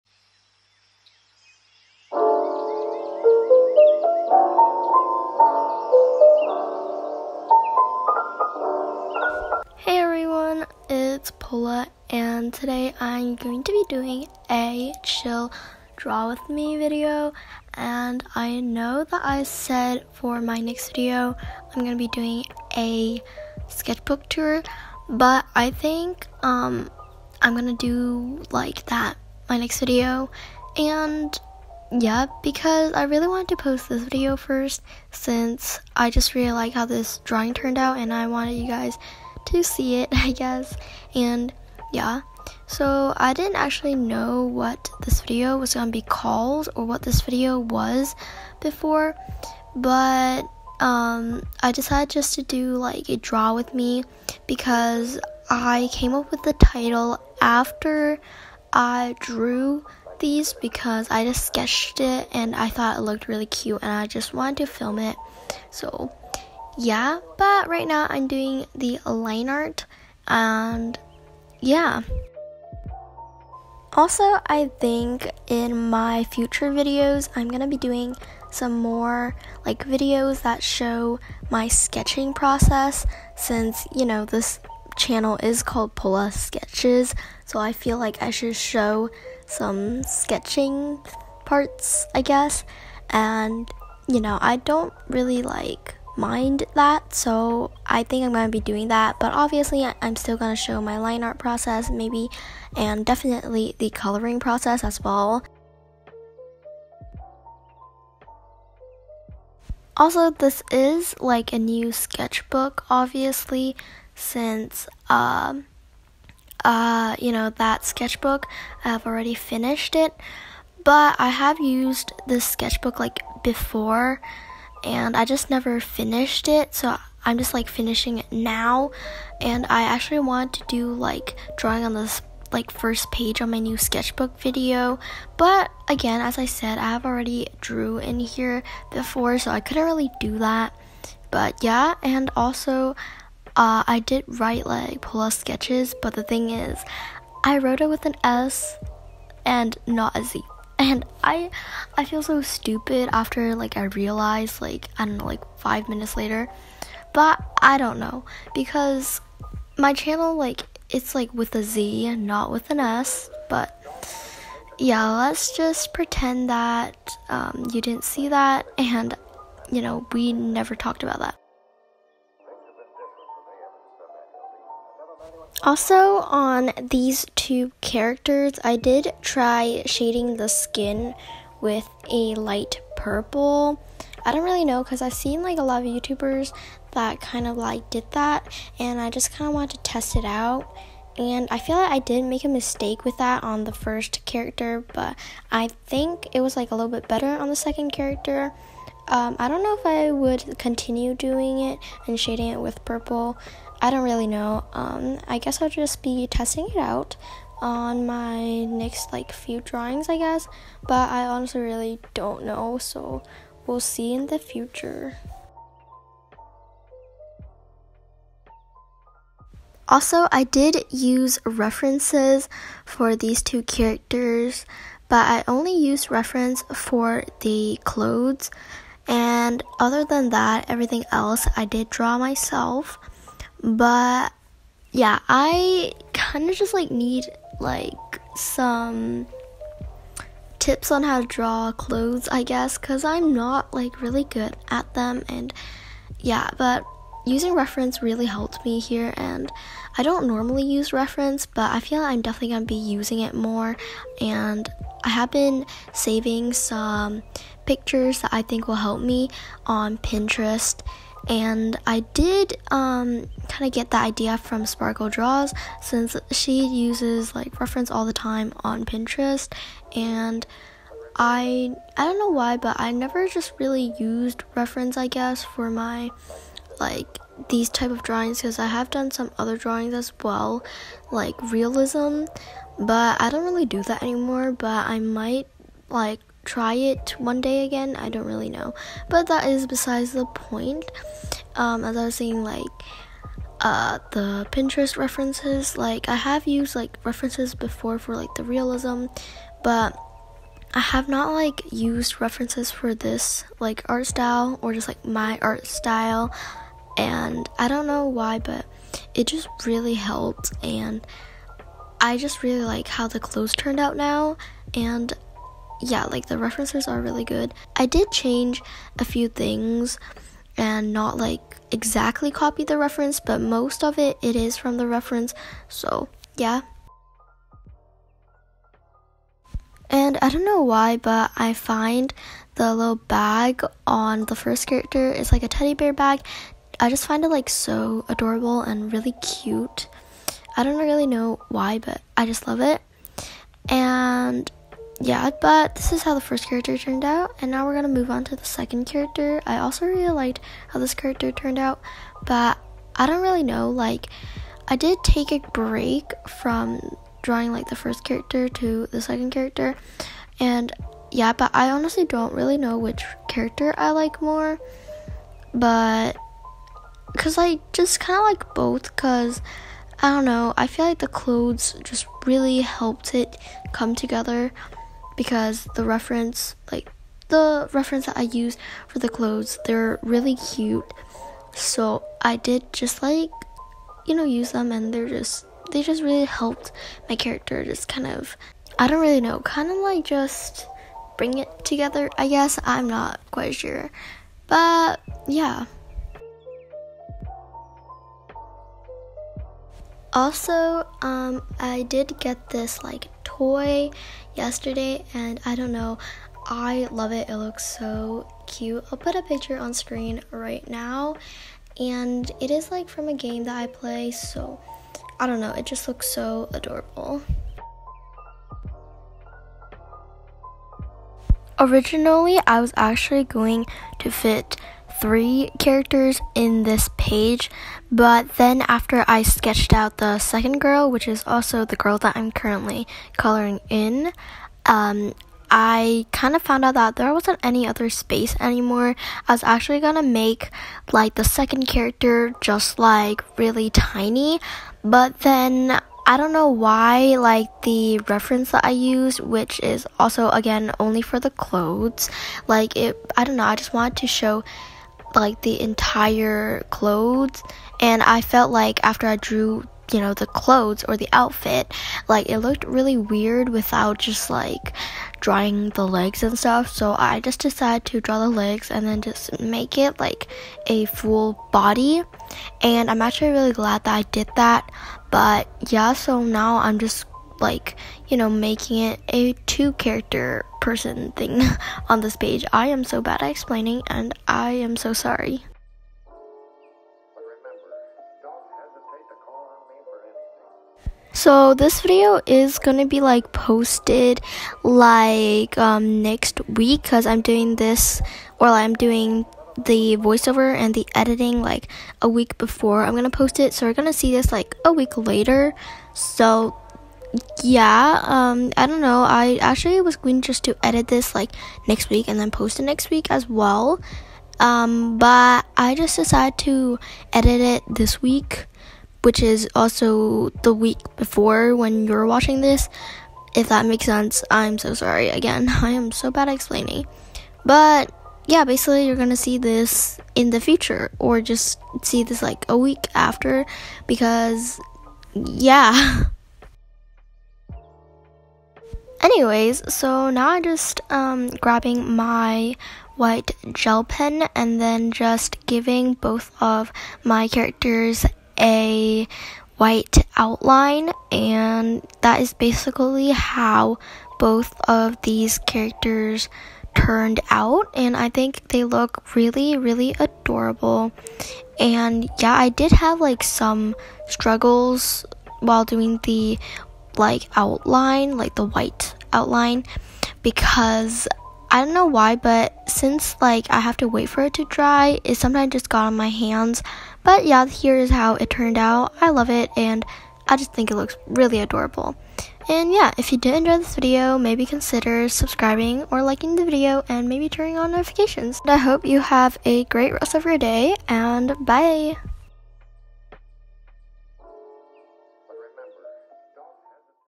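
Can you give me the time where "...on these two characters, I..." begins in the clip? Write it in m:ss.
2:56.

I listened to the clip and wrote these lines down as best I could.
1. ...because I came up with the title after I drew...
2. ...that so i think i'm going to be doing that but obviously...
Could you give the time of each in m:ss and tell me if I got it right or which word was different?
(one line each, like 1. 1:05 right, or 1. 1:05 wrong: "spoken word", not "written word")
1. 0:54 right
2. 1:36 right.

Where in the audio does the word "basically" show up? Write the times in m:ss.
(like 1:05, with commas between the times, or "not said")
8:48, 9:12.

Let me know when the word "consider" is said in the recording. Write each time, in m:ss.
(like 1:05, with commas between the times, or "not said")
9:44.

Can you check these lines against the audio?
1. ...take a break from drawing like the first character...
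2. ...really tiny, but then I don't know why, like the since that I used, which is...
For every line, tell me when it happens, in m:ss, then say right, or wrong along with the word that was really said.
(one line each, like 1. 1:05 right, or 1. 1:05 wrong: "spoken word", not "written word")
1. 5:55 right
2. 7:23 wrong: "reference", not "since".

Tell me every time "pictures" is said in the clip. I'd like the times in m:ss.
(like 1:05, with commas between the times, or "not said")
4:17, 6:49.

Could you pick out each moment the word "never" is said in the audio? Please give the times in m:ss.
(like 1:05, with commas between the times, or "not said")
2:05, 2:50, 4:32.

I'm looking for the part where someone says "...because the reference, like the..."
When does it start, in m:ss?
6:15.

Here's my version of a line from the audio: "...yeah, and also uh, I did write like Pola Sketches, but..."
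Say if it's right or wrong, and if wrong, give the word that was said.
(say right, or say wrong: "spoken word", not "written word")
right.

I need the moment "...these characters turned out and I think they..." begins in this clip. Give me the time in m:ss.
9:15.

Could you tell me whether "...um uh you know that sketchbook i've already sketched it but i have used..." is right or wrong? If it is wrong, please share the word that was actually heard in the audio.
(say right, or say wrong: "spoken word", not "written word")
wrong: "finished", not "sketched".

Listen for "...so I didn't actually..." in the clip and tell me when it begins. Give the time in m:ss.
0:42.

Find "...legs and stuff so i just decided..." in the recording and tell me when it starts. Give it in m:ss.
7:45.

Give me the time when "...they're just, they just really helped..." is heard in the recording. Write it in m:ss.
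6:24.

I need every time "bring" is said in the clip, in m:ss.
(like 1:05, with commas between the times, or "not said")
6:31.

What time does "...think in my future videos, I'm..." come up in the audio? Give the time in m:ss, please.
1:14.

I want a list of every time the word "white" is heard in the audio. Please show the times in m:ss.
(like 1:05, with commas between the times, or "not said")
9:02, 9:09, 9:28.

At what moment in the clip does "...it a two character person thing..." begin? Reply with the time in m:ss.
7:58.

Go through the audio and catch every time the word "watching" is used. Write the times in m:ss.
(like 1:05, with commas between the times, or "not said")
8:42.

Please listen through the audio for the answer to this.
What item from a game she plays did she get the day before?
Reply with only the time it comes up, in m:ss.
6:43.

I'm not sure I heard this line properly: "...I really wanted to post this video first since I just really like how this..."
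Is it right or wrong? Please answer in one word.
right.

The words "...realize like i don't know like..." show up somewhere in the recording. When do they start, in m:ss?
2:33.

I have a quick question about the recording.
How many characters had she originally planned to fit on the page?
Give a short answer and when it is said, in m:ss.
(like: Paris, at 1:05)
3, at 7:05.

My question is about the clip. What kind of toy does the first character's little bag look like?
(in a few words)
teddy bear.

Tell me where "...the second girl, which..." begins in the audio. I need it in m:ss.
7:09.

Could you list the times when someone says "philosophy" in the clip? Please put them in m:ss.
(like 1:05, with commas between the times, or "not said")
not said.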